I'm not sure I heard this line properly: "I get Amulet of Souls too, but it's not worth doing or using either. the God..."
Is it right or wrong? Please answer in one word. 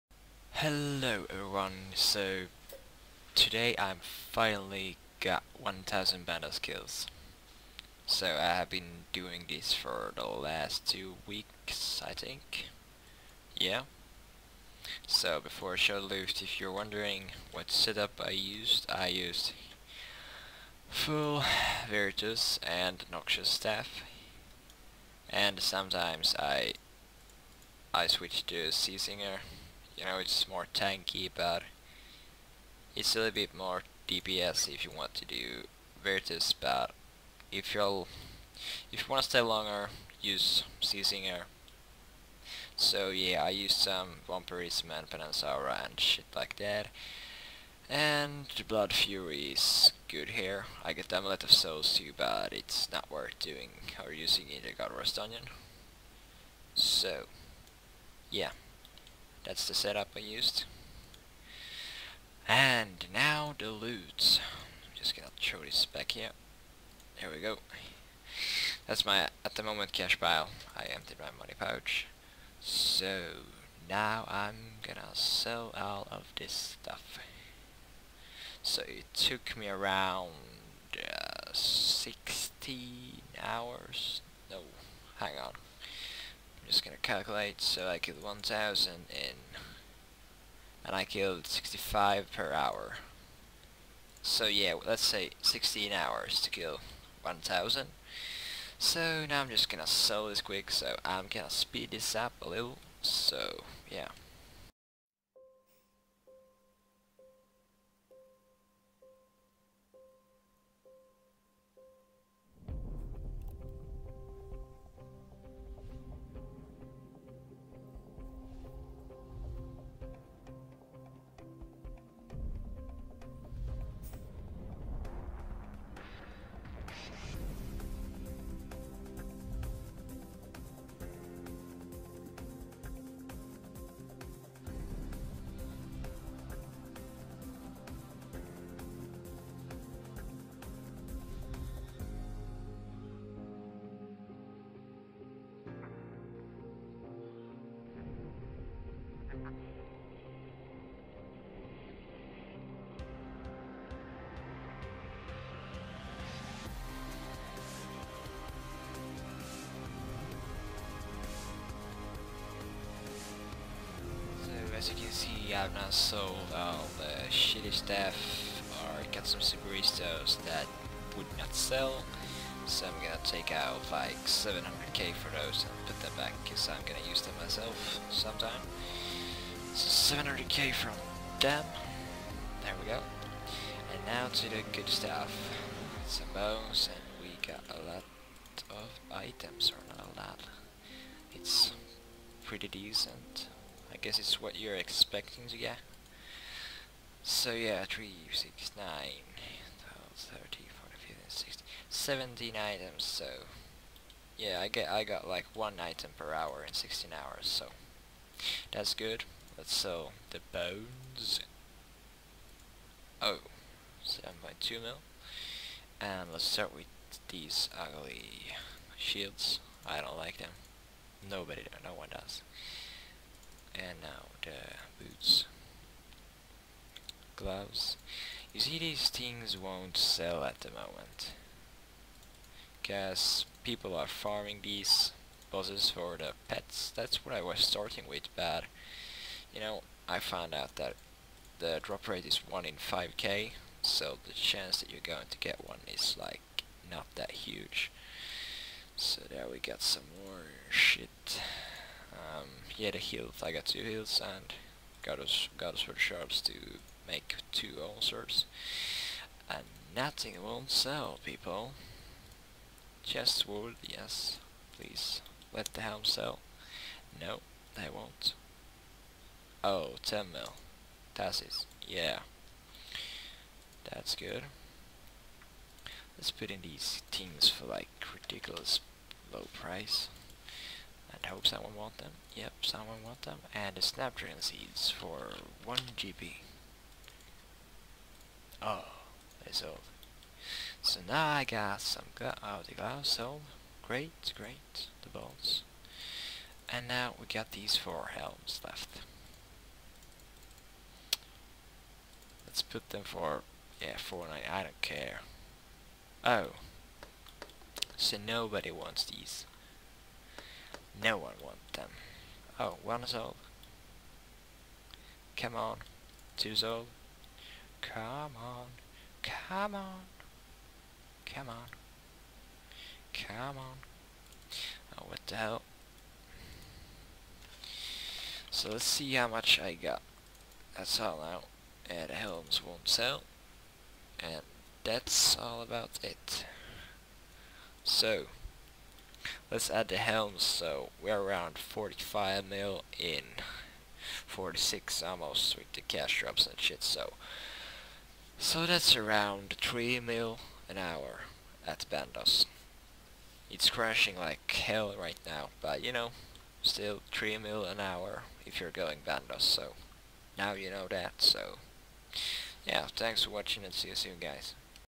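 right.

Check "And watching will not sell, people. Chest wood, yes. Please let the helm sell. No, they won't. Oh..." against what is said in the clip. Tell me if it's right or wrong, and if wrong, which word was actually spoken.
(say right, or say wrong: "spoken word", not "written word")
wrong: "nothing", not "watching".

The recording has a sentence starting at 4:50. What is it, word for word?
So now I got some gla oh the glass sold.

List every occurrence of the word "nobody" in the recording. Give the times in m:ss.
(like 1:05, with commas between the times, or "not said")
3:41, 5:08.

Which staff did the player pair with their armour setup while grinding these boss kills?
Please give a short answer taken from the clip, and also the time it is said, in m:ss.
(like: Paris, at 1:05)
Noxious Staff, at 0:23.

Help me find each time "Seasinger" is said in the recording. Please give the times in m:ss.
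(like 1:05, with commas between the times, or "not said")
0:28, 0:40.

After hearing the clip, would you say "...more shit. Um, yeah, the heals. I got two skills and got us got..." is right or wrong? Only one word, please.
wrong.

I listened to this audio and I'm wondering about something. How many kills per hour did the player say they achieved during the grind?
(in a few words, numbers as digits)
65.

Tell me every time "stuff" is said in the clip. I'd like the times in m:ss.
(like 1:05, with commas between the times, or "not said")
1:16, 2:47, 3:04.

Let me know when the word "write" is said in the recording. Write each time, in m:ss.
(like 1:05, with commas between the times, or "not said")
not said.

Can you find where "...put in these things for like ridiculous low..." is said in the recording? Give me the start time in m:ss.
4:36.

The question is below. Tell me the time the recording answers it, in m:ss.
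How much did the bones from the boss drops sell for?
3:34.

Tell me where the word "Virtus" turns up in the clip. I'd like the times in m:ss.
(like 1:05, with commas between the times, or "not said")
0:21, 0:36.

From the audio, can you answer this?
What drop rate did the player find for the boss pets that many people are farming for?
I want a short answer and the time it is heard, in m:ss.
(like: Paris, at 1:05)
1 in 5k, at 4:02.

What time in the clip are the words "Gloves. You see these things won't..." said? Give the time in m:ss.
3:47.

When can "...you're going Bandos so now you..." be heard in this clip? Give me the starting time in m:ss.
5:58.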